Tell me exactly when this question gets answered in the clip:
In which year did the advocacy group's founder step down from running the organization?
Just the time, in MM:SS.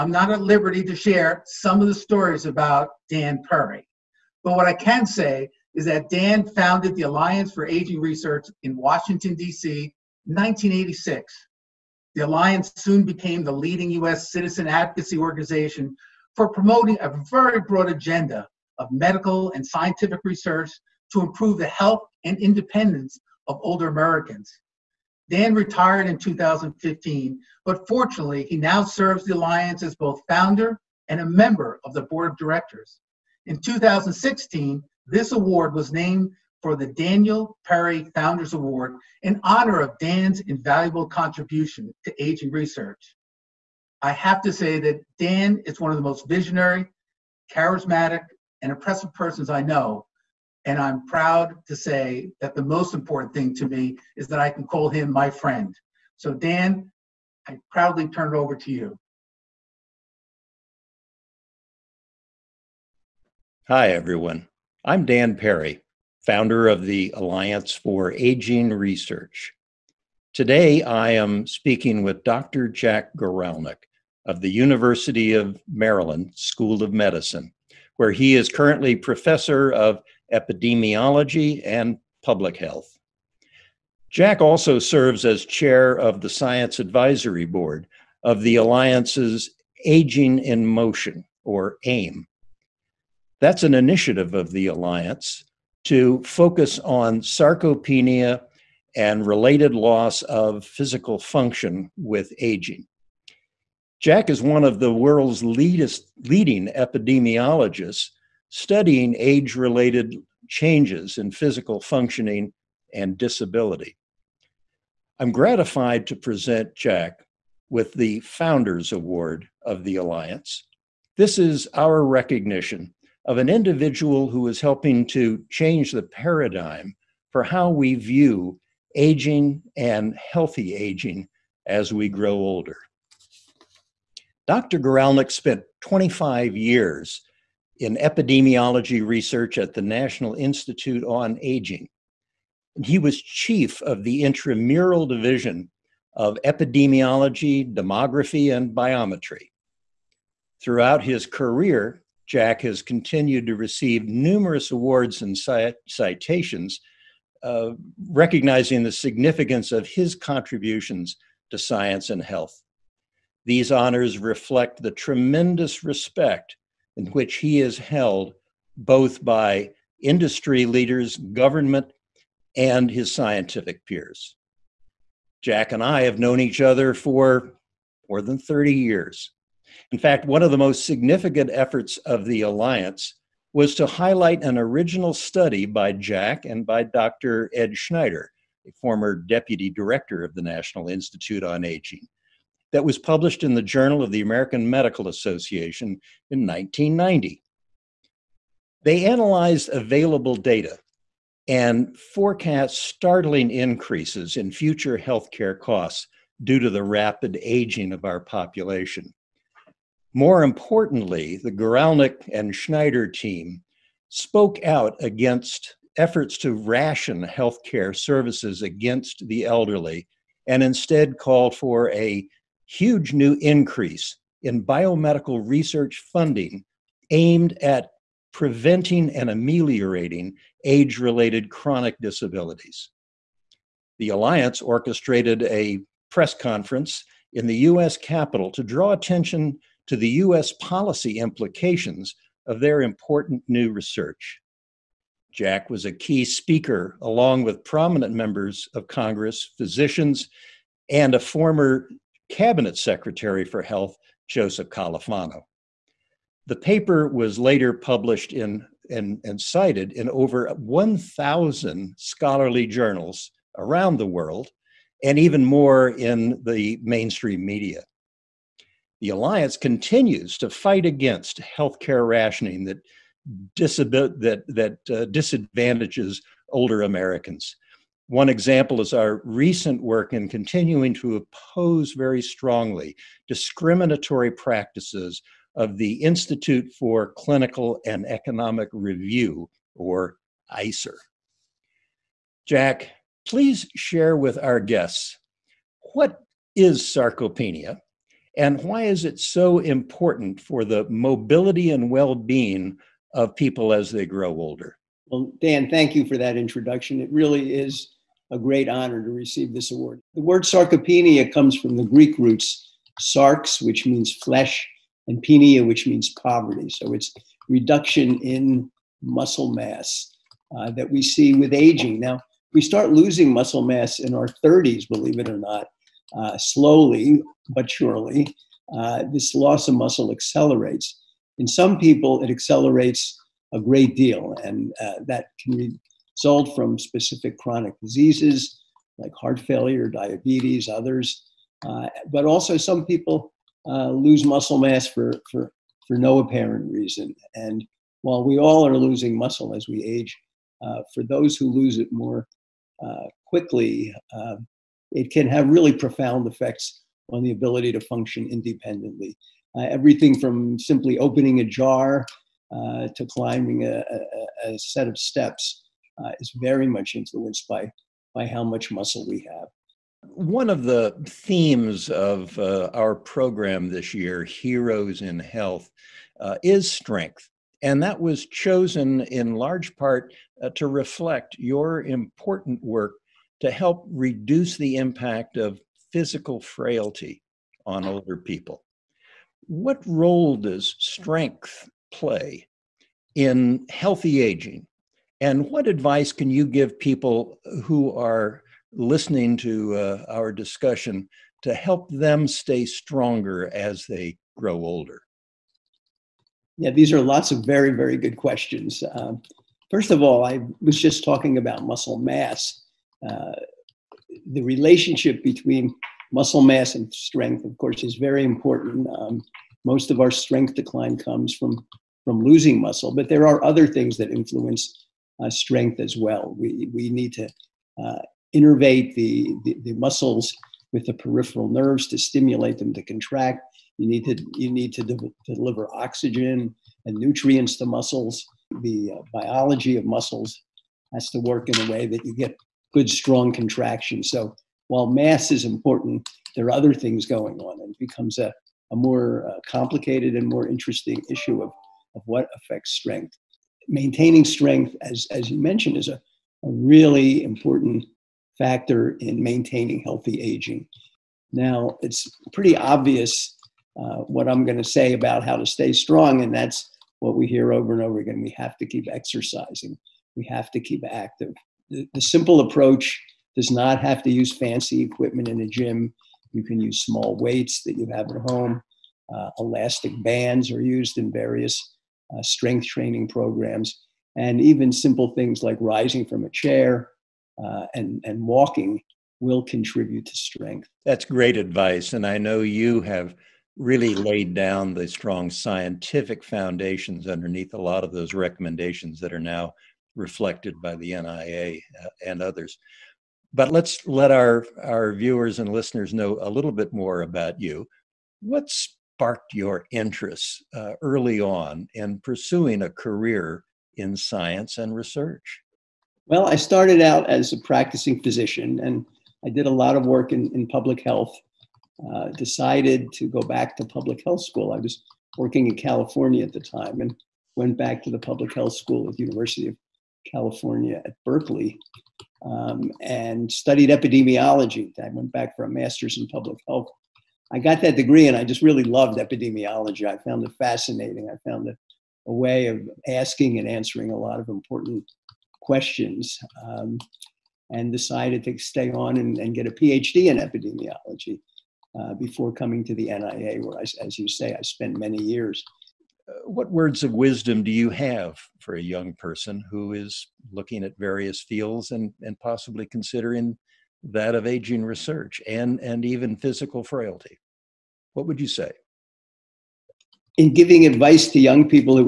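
00:26.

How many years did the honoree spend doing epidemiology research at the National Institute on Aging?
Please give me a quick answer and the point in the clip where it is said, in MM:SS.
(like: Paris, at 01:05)
25, at 02:15.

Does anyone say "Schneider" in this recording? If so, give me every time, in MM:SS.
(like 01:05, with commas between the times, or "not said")
03:07, 03:32.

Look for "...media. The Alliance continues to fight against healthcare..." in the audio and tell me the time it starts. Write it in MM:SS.
04:27.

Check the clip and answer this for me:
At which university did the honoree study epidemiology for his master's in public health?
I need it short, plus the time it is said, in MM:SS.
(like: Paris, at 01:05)
University of California at Berkeley, at 08:49.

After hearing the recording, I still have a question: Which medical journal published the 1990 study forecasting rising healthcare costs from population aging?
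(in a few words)
Journal of the American Medical Association.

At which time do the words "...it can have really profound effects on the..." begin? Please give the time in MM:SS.
05:54.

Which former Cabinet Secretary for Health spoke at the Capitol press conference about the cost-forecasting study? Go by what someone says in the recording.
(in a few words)
Joseph Califano.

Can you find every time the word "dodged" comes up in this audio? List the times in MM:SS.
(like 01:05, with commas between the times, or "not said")
not said.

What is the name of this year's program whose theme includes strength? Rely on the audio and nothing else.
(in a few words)
Heroes in Health.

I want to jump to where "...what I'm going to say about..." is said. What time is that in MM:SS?
07:43.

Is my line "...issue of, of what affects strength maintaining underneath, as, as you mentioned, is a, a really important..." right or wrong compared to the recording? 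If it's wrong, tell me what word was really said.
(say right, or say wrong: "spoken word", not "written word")
wrong: "strength", not "underneath".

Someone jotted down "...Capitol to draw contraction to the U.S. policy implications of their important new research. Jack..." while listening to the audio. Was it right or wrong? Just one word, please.
wrong.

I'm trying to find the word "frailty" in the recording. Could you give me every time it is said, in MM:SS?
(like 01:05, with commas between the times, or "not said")
06:26, 09:26.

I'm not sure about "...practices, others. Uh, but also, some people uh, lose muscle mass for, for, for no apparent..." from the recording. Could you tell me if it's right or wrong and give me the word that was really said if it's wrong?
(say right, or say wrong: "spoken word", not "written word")
wrong: "diabetes", not "practices".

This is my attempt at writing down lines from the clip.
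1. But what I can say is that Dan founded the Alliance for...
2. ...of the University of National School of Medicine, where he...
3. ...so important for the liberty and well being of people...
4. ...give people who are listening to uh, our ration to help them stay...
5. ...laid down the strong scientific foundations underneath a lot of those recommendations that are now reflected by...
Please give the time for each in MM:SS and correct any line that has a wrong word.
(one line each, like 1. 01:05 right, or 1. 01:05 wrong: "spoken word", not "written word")
1. 00:04 right
2. 01:14 wrong: "Maryland", not "National"
3. 04:59 wrong: "mobility", not "liberty"
4. 06:36 wrong: "discussion", not "ration"
5. 08:13 right.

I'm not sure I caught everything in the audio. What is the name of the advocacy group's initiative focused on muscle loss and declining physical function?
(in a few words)
Aging in Motion.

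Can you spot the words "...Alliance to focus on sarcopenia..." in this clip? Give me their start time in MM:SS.
01:34.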